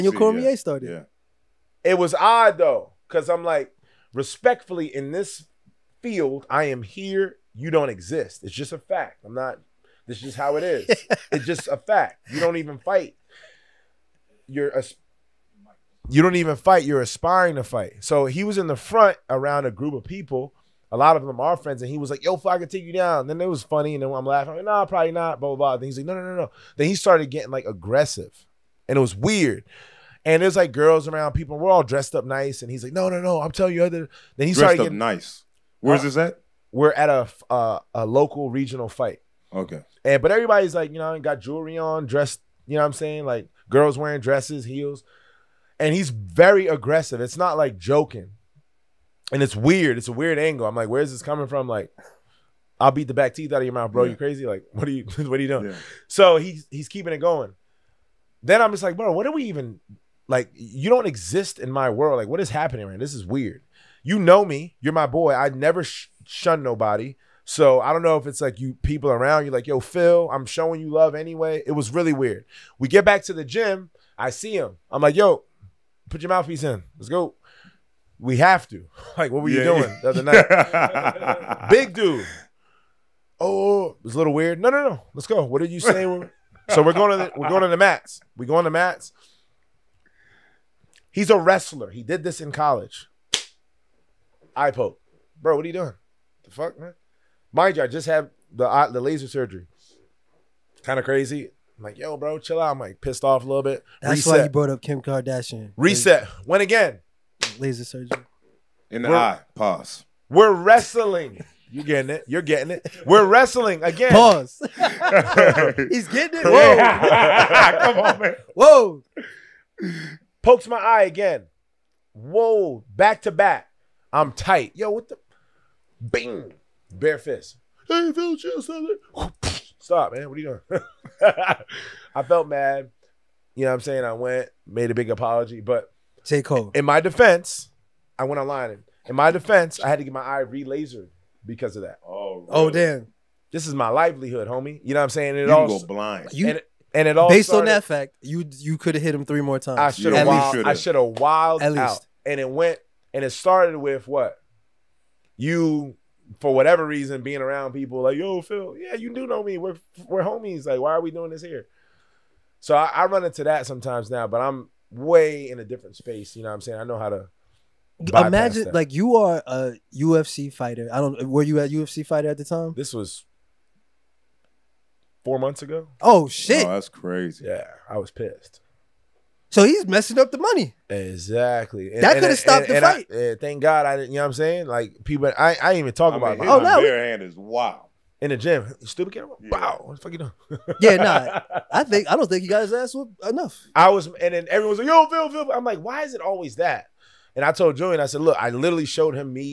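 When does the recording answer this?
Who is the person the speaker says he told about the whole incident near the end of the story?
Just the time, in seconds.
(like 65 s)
197 s.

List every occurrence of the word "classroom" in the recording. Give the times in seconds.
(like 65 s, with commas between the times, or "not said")
not said.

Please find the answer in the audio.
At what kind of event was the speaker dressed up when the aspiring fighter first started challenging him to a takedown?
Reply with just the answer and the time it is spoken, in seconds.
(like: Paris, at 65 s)
local regional fight, at 37 s.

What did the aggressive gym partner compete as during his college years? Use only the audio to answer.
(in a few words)
Wrestler.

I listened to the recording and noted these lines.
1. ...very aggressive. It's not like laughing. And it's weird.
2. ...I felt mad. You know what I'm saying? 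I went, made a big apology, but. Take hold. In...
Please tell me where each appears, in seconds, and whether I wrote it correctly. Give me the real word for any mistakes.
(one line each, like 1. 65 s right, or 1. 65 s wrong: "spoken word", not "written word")
1. 46 s wrong: "joking", not "laughing"
2. 132 s right.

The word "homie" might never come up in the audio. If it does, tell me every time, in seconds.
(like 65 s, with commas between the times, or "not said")
144 s, 160 s.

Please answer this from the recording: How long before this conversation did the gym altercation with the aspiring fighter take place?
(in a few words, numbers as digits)
4 months ago.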